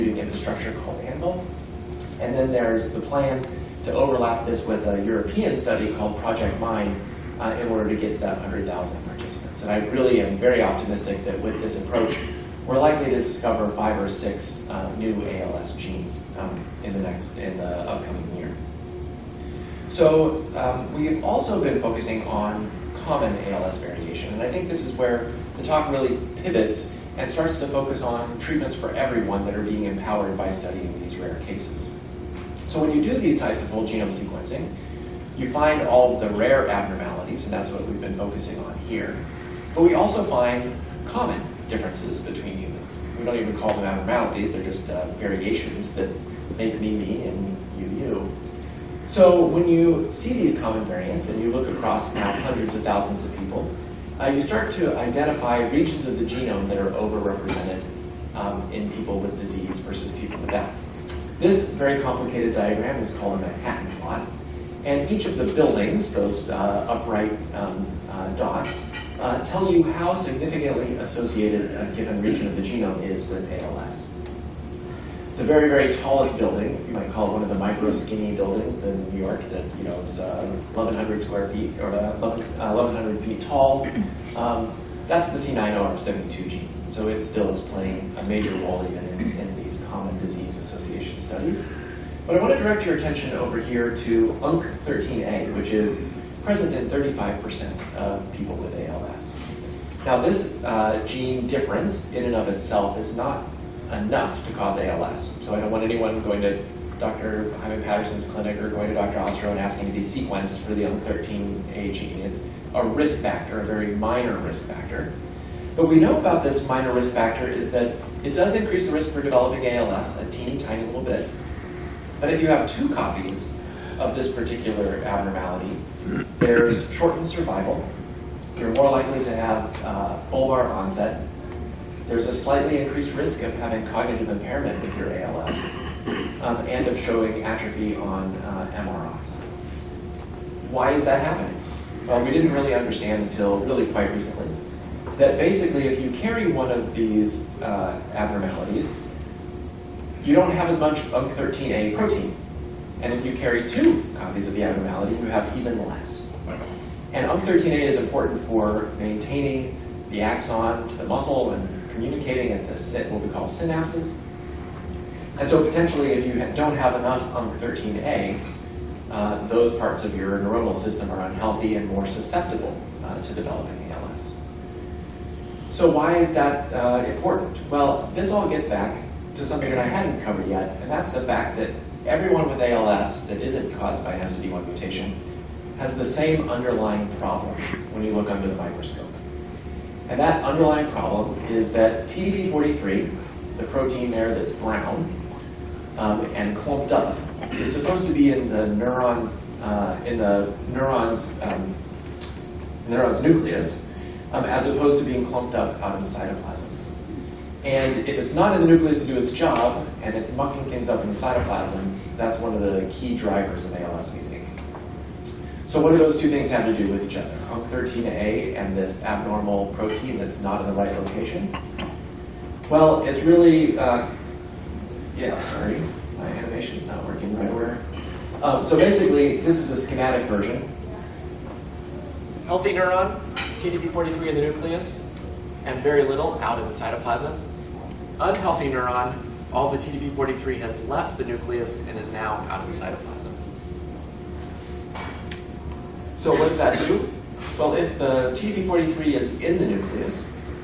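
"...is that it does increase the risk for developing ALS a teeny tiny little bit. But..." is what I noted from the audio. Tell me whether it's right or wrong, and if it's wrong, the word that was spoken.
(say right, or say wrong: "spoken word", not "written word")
right.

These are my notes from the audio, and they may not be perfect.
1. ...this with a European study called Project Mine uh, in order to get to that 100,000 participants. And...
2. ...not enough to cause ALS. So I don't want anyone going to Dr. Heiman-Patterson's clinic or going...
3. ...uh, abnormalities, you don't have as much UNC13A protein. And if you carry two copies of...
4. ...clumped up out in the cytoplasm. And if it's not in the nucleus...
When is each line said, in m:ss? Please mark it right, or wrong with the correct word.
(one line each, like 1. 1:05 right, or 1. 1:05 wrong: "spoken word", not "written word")
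1. 0:04 right
2. 1:43 right
3. 2:27 right
4. 3:25 right.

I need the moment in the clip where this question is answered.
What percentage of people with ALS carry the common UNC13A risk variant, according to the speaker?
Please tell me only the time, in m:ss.
1:36.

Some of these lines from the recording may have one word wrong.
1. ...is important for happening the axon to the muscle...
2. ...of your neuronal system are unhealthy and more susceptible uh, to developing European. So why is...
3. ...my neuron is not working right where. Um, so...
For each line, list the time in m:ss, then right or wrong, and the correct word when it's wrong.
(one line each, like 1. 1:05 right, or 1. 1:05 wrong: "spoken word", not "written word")
1. 2:37 wrong: "maintaining", not "happening"
2. 2:50 wrong: "ALS", not "European"
3. 3:46 wrong: "animation", not "neuron".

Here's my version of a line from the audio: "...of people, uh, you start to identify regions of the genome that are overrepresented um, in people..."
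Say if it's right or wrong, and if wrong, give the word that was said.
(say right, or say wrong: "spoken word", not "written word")
right.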